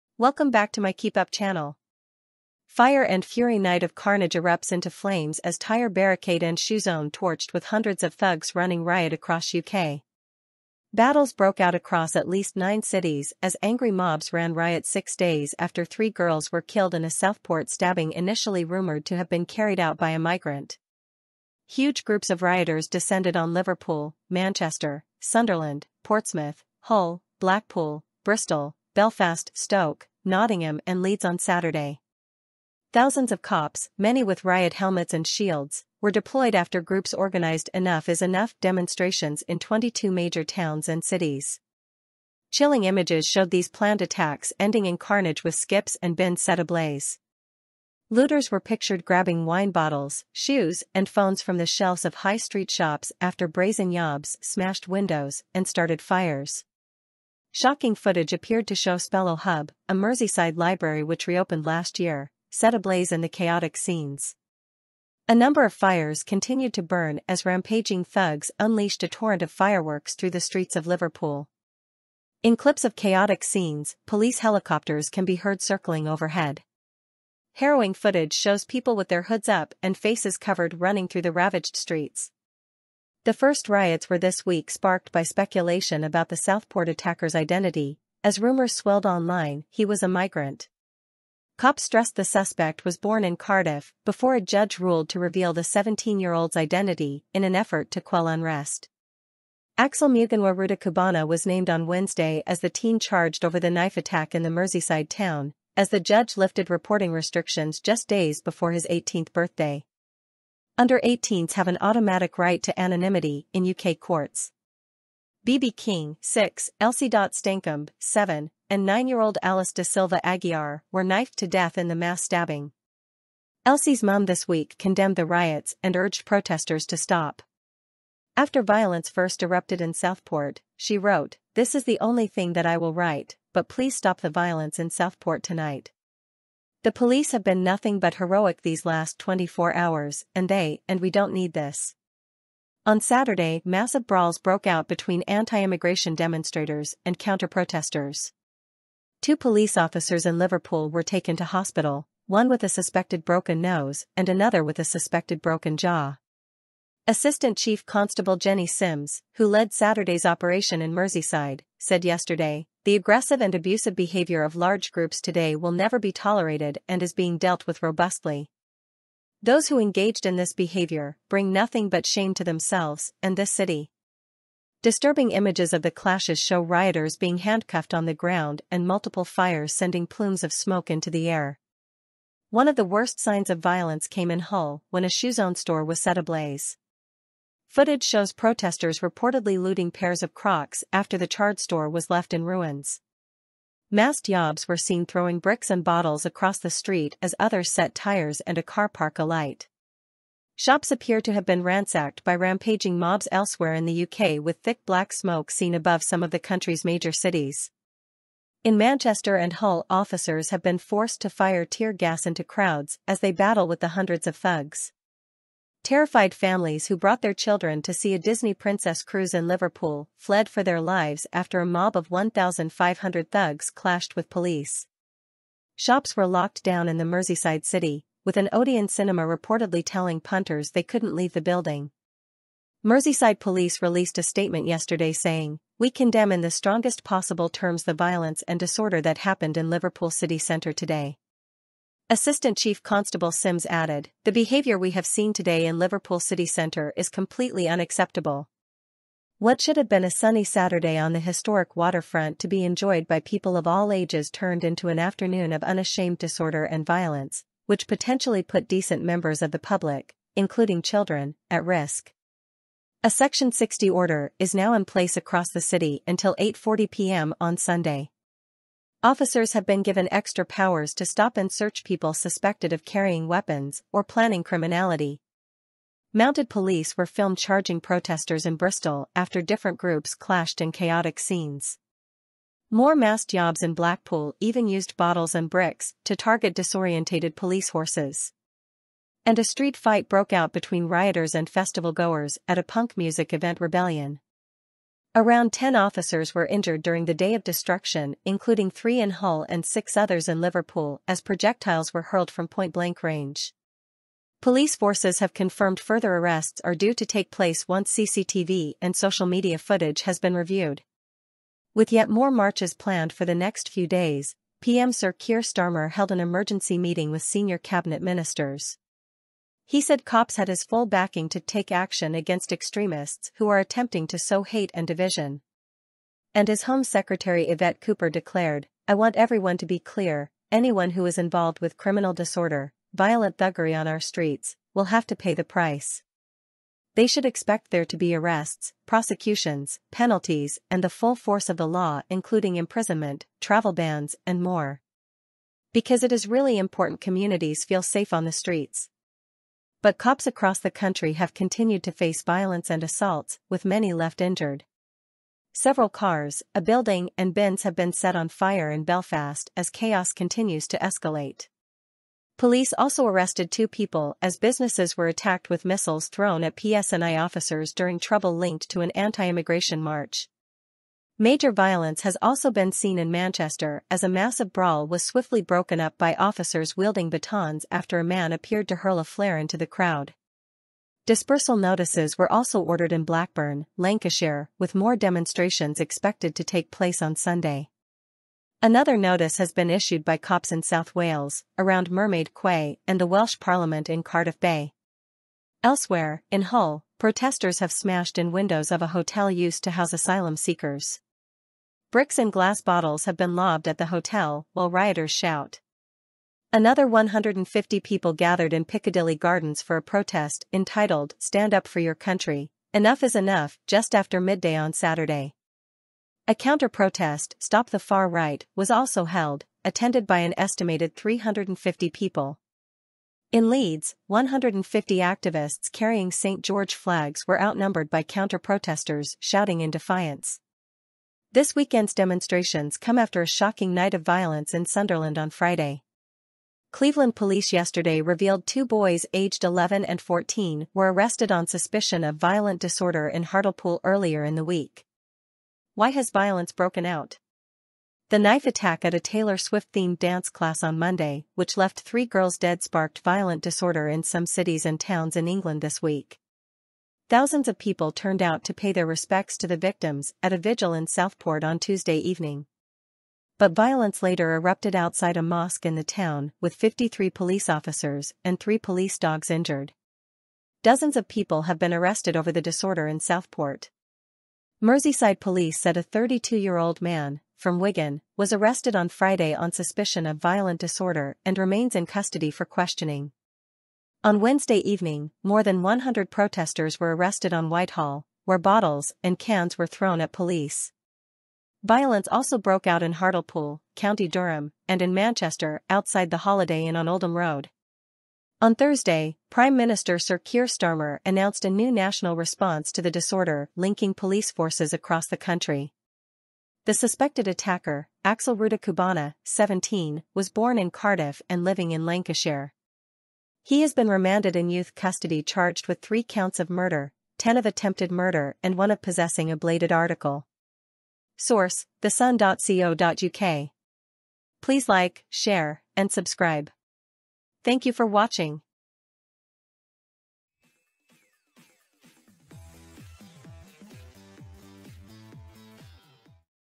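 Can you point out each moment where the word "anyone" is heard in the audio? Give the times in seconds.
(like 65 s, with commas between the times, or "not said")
330 s.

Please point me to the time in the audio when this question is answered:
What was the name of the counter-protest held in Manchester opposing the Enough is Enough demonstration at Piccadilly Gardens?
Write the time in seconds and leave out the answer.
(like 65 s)
417 s.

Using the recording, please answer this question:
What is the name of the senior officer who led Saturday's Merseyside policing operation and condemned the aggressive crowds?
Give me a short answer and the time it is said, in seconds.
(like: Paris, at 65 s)
Jenny Sims, at 158 s.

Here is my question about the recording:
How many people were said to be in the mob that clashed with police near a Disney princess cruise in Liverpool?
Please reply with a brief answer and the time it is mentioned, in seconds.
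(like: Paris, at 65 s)
1,500, at 222 s.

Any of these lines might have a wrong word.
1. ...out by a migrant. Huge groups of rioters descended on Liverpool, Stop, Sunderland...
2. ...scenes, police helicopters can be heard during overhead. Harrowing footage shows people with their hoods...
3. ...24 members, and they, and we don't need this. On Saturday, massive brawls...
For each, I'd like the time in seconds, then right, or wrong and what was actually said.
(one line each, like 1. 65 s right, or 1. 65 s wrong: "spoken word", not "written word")
1. 19 s wrong: "Manchester", not "Stop"
2. 73 s wrong: "circling", not "during"
3. 139 s wrong: "hours", not "members".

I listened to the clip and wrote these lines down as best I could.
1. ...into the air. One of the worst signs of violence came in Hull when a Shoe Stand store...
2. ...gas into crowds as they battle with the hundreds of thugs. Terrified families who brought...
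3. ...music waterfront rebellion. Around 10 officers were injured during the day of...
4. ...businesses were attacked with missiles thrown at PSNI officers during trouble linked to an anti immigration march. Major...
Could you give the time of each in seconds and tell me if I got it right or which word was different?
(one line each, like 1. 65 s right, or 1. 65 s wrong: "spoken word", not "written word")
1. 180 s wrong: "Zone", not "Stand"
2. 211 s right
3. 292 s wrong: "event", not "waterfront"
4. 364 s right.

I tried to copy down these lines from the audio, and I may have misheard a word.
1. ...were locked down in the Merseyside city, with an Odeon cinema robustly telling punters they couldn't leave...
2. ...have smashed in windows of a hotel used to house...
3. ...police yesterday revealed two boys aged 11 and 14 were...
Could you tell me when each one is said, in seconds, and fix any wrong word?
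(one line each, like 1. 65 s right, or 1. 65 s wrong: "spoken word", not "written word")
1. 226 s wrong: "reportedly", not "robustly"
2. 397 s right
3. 437 s right.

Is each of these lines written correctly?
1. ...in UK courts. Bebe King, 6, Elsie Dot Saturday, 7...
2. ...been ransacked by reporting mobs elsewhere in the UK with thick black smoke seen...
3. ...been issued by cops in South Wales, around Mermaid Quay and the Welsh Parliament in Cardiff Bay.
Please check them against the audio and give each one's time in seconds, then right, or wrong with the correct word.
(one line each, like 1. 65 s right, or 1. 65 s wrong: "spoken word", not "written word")
1. 113 s wrong: "Stancombe", not "Saturday"
2. 201 s wrong: "rampaging", not "reporting"
3. 389 s right.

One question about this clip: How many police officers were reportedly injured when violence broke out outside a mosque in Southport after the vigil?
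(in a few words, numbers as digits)
53.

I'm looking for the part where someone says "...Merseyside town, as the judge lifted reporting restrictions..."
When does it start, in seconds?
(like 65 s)
104 s.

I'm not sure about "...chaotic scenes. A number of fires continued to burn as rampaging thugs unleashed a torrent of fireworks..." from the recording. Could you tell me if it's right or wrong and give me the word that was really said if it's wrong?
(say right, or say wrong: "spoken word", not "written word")
right.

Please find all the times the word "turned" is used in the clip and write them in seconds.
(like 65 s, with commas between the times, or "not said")
254 s, 457 s.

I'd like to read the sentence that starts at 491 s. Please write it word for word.
Violence also broke out in Hartlepool, County Durham, and in Manchester outside the Holiday Inn on Oldham Road.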